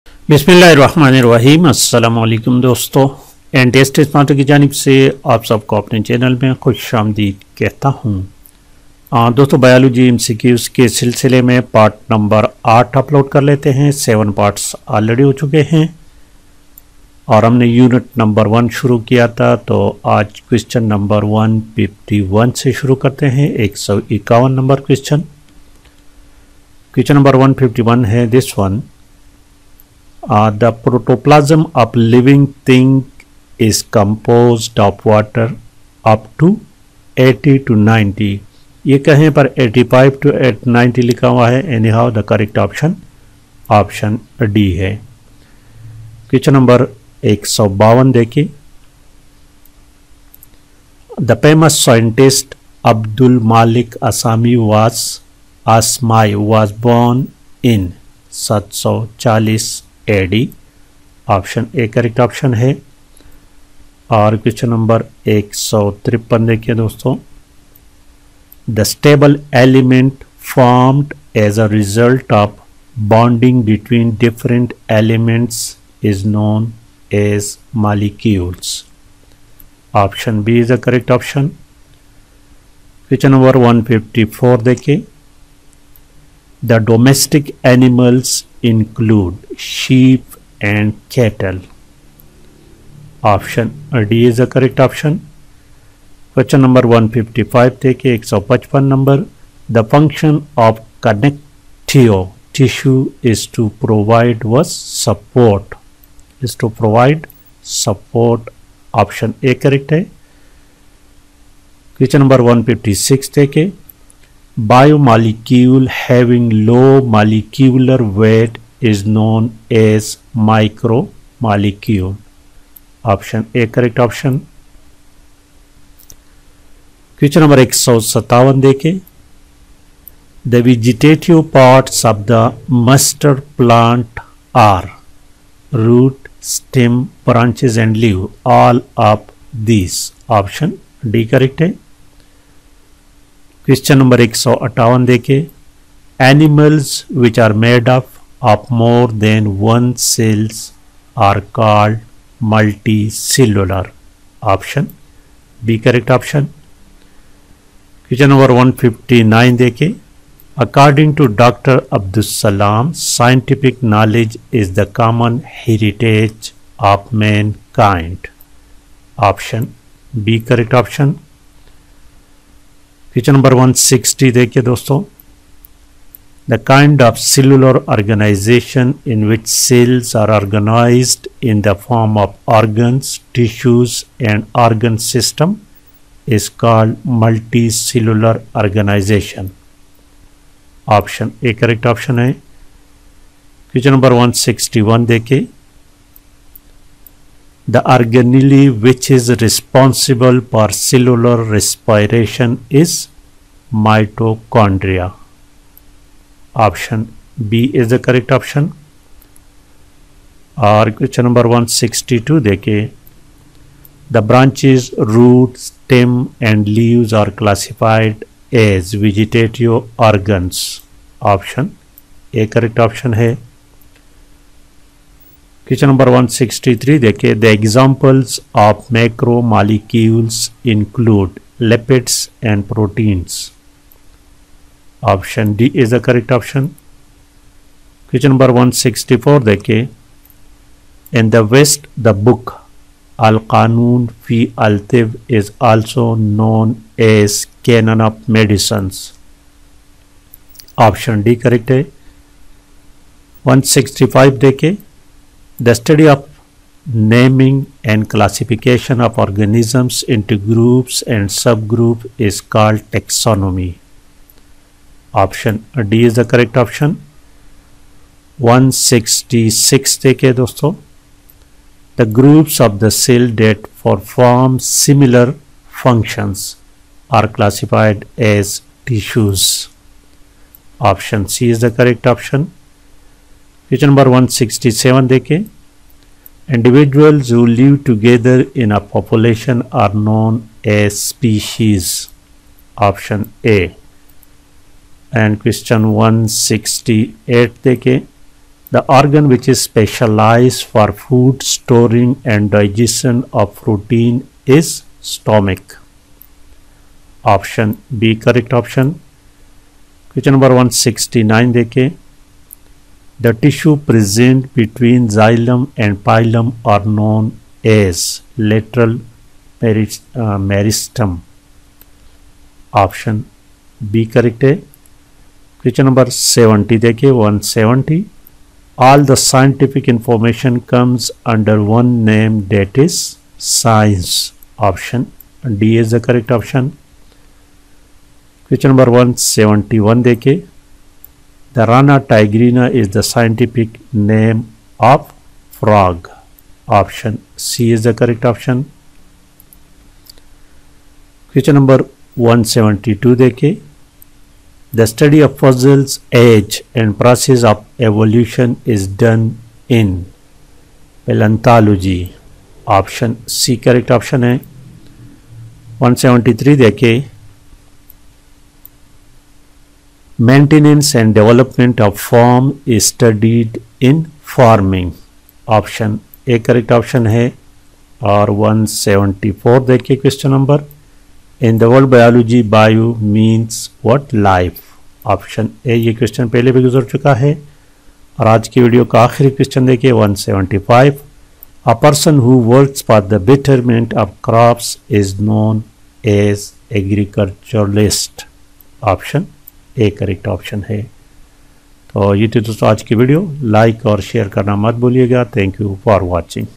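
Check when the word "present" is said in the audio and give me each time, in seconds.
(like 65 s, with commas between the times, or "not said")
313 s.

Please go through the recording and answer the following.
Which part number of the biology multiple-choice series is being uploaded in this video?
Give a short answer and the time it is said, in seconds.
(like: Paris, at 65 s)
8, at 12 s.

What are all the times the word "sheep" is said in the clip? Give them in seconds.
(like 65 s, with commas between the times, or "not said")
89 s.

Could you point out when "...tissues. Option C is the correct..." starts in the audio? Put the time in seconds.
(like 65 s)
278 s.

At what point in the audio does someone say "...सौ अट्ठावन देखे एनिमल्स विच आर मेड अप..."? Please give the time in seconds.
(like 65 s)
144 s.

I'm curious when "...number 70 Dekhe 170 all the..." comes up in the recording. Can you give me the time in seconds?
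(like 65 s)
325 s.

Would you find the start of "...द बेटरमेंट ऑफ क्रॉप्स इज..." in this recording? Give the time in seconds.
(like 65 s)
393 s.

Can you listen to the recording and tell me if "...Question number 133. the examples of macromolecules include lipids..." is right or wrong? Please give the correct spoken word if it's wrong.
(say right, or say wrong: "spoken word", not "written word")
wrong: "163", not "133".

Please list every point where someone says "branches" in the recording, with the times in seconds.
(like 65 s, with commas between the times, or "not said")
137 s, 214 s.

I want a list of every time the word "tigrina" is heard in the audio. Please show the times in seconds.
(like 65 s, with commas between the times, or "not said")
341 s.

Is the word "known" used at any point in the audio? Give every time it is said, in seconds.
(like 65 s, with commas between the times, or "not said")
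119 s, 246 s, 290 s, 316 s.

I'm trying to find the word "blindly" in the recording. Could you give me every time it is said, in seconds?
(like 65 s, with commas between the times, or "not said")
not said.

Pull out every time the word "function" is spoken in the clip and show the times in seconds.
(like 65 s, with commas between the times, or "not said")
99 s, 275 s.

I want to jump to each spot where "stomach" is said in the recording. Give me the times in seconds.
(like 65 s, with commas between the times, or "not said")
305 s.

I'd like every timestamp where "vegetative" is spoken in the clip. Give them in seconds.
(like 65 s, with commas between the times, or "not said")
130 s, 219 s.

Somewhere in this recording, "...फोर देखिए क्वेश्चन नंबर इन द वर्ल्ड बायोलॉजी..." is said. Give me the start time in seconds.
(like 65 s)
379 s.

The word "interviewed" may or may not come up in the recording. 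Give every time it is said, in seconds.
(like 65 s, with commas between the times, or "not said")
not said.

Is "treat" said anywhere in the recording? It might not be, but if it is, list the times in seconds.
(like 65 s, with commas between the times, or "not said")
not said.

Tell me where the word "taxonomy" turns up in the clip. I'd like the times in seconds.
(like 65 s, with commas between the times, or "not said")
262 s.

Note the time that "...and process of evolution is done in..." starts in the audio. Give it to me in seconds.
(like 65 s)
356 s.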